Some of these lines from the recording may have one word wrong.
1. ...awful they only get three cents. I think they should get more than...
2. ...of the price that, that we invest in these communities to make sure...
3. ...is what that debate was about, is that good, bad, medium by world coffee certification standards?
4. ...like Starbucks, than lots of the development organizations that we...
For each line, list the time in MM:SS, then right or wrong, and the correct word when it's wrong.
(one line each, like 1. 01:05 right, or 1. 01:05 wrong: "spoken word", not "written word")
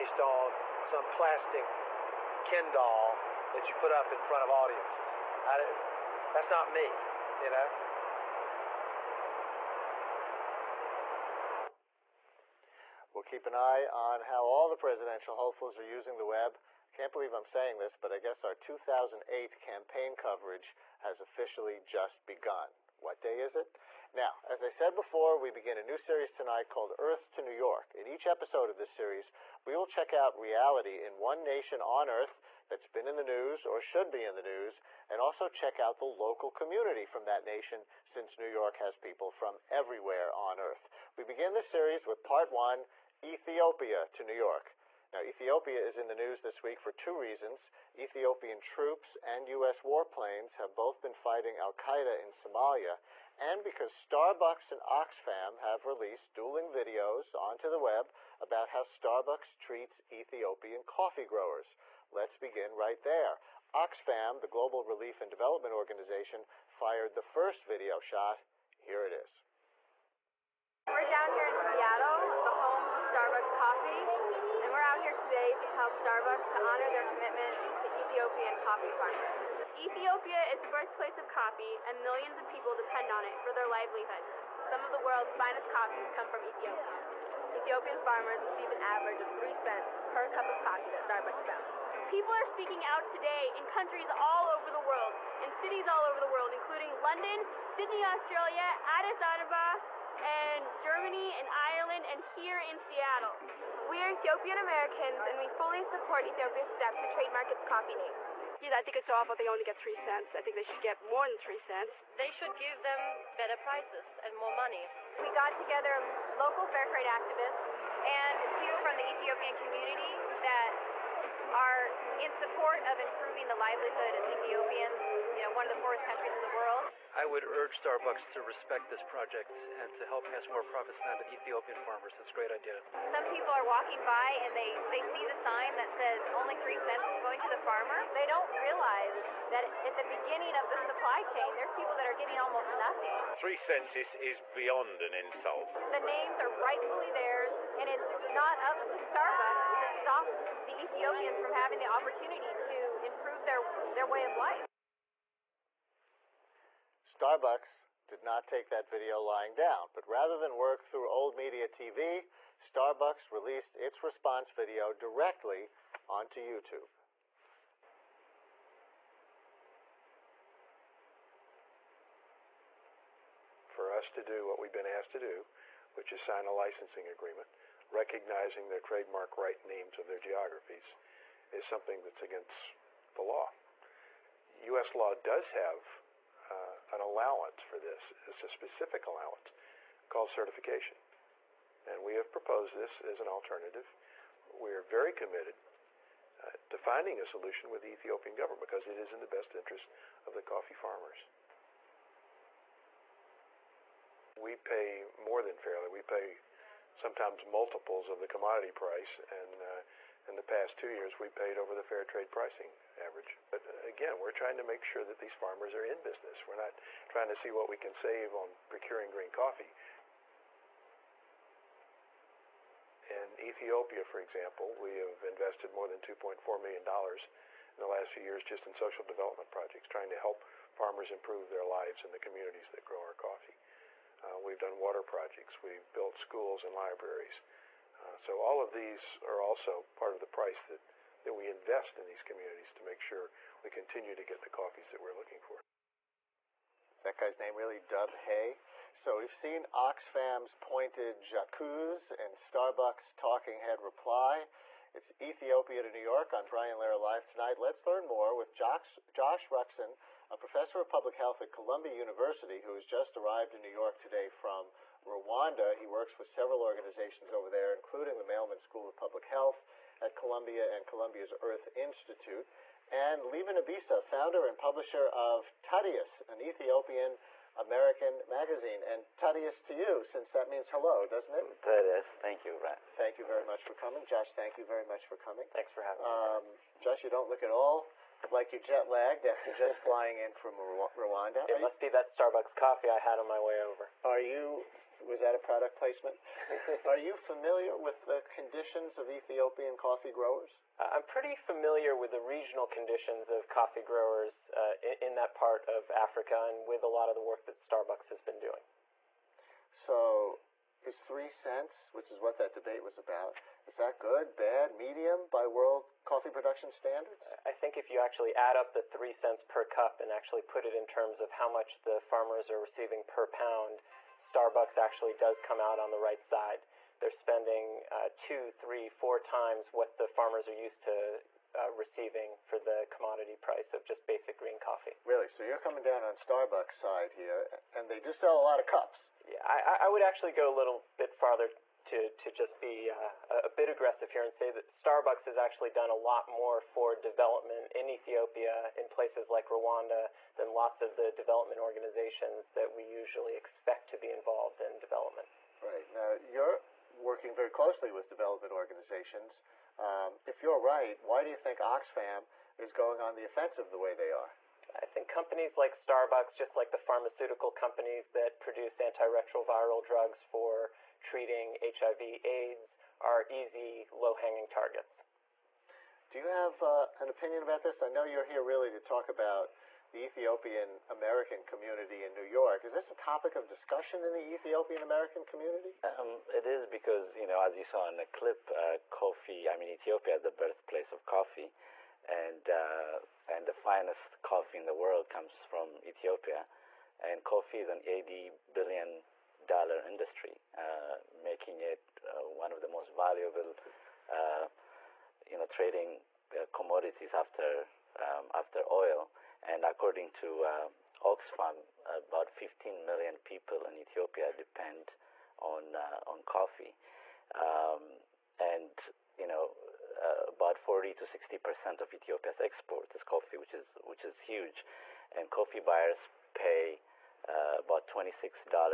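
1. 01:49 right
2. 04:00 right
3. 05:12 wrong: "production", not "certification"
4. 05:49 wrong: "Rwanda", not "Starbucks".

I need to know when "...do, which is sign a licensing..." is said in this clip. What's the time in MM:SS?
02:55.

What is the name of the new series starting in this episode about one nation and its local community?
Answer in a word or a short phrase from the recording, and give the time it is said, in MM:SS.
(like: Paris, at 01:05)
Earth to New York, at 00:26.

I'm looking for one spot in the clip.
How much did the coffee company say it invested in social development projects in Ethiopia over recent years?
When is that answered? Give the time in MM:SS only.
03:45.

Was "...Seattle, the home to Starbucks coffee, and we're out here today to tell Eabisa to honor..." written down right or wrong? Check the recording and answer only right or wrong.
wrong.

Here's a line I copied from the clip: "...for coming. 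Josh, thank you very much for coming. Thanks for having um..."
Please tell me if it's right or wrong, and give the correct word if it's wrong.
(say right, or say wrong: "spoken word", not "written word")
right.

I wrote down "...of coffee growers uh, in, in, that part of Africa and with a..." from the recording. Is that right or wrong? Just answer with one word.
right.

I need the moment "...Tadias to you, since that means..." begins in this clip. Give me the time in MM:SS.
04:39.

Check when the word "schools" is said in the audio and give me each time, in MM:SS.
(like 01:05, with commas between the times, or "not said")
03:56, 04:28.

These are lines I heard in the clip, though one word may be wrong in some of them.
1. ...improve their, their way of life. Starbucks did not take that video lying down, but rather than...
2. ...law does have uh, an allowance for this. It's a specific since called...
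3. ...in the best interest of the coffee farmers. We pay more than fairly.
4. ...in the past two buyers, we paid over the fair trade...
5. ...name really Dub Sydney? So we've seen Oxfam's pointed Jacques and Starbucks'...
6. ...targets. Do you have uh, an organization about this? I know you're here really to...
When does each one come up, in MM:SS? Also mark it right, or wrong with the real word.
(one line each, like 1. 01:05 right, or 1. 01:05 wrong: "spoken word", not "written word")
1. 02:33 right
2. 03:04 wrong: "allowance", not "since"
3. 03:19 right
4. 03:30 wrong: "years", not "buyers"
5. 04:07 wrong: "Hay", not "Sydney"
6. 06:14 wrong: "opinion", not "organization".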